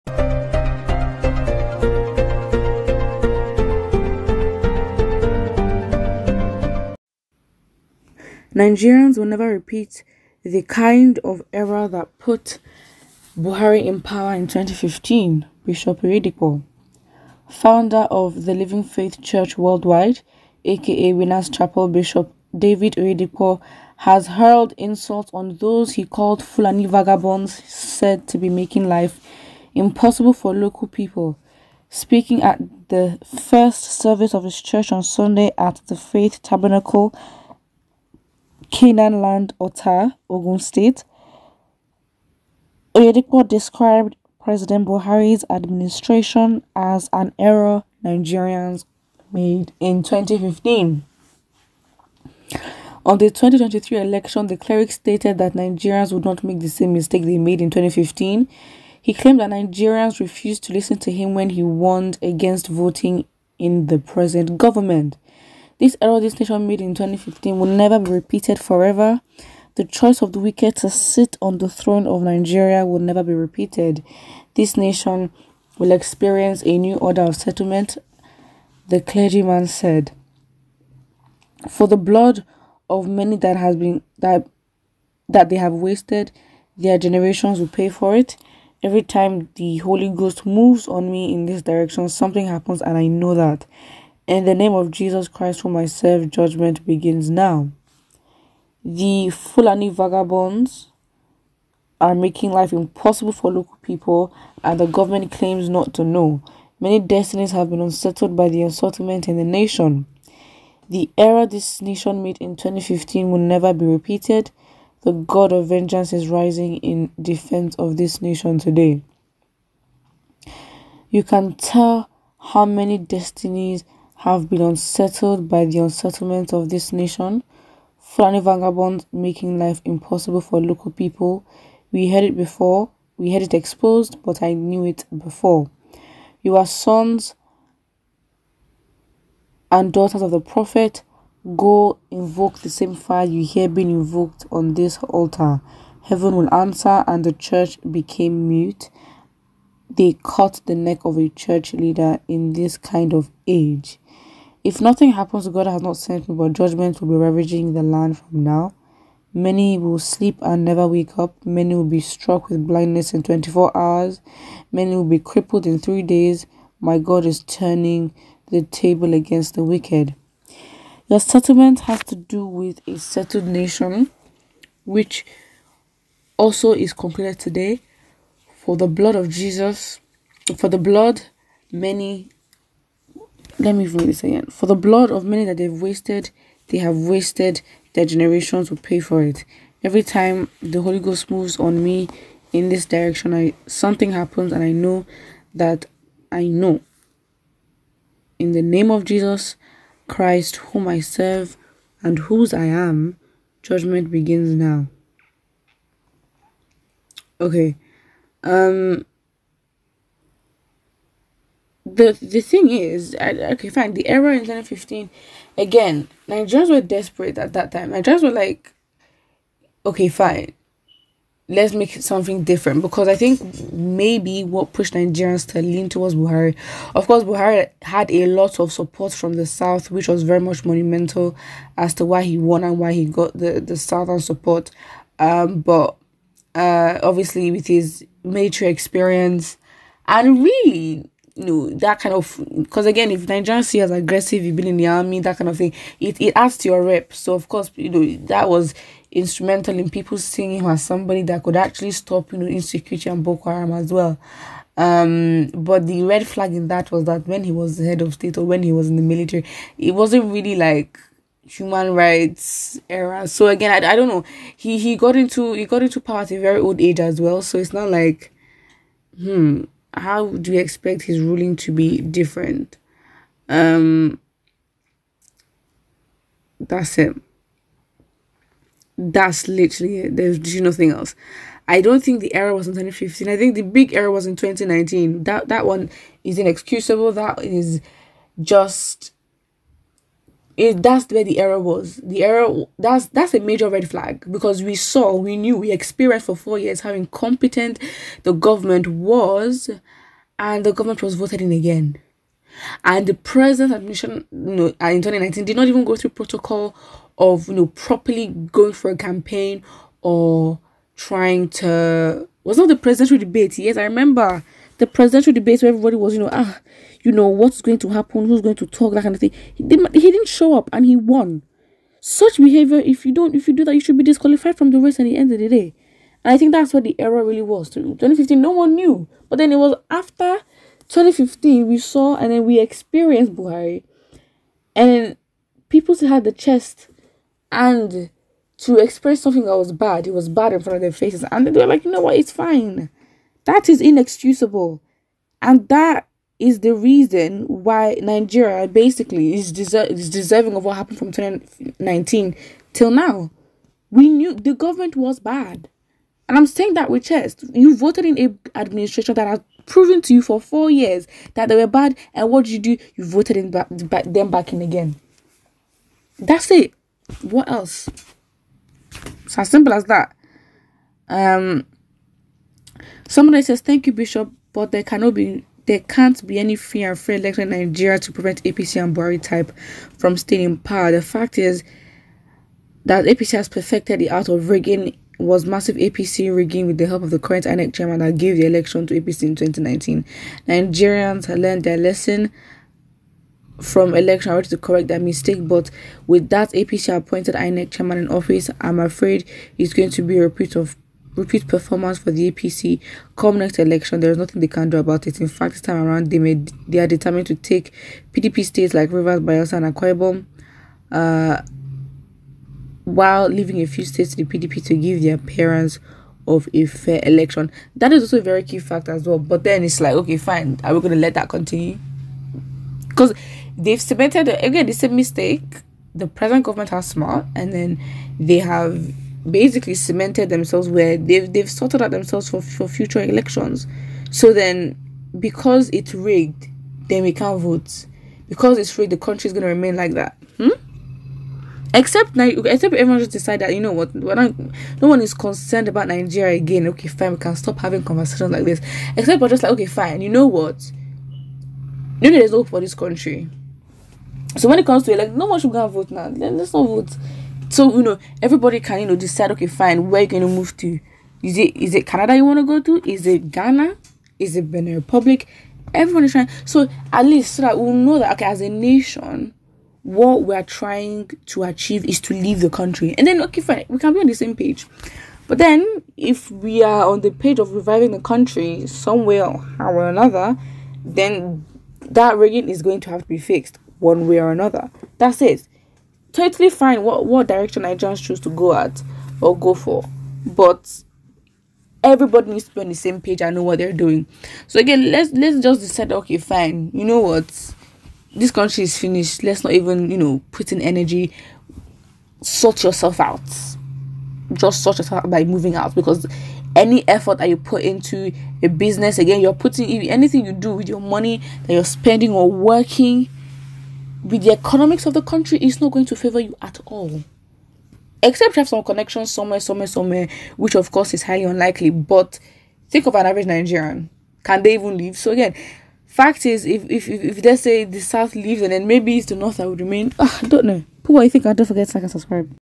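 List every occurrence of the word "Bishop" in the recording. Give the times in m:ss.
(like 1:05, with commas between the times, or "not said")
0:15, 0:21, 6:13.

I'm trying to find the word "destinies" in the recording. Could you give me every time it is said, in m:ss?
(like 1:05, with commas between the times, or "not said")
1:46, 2:02.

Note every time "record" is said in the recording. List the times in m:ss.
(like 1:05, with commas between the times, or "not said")
not said.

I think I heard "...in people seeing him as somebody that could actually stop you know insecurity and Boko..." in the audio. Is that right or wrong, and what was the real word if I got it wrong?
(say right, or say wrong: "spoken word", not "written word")
right.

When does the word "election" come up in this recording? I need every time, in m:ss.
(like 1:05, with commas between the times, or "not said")
0:53, 6:17, 6:28, 6:33, 6:43, 6:57, 7:13.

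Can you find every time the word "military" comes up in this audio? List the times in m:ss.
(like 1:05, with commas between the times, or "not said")
3:58, 4:19.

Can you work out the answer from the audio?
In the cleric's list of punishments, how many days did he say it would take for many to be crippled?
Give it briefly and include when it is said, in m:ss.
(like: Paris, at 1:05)
3, at 2:45.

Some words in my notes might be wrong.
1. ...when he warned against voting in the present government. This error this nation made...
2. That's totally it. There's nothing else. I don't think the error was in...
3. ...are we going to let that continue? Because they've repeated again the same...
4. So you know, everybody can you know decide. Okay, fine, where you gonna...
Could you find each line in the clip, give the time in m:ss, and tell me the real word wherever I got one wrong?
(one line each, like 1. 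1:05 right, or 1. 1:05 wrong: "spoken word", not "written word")
1. 1:01 right
2. 4:38 wrong: "literally", not "totally"
3. 7:00 wrong: "cemented", not "repeated"
4. 7:37 right.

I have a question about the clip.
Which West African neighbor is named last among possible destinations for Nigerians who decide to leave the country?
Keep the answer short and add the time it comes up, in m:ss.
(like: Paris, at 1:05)
Benin Republic, at 7:44.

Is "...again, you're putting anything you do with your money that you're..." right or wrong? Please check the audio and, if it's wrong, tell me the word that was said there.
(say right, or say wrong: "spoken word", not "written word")
right.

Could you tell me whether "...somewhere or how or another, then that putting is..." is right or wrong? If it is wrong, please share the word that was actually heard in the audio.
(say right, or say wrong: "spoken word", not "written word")
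wrong: "rigging", not "putting".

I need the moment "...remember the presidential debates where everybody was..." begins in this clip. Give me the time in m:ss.
5:13.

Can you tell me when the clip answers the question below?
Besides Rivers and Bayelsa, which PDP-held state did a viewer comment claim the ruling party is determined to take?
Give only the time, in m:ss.
6:49.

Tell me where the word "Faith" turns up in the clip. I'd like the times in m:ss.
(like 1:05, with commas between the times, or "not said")
0:18, 0:35.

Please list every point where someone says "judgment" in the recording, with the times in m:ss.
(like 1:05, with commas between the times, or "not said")
1:36, 2:36, 3:23.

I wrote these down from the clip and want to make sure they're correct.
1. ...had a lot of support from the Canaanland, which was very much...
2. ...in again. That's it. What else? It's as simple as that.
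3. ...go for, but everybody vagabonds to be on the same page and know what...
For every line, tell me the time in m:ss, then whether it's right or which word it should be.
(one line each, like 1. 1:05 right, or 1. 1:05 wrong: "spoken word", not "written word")
1. 3:47 wrong: "South", not "Canaanland"
2. 6:04 right
3. 8:09 wrong: "needs", not "vagabonds".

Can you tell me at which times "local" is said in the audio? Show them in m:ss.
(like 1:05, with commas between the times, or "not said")
0:30, 1:43, 2:10.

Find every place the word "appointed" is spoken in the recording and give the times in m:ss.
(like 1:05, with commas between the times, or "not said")
6:36.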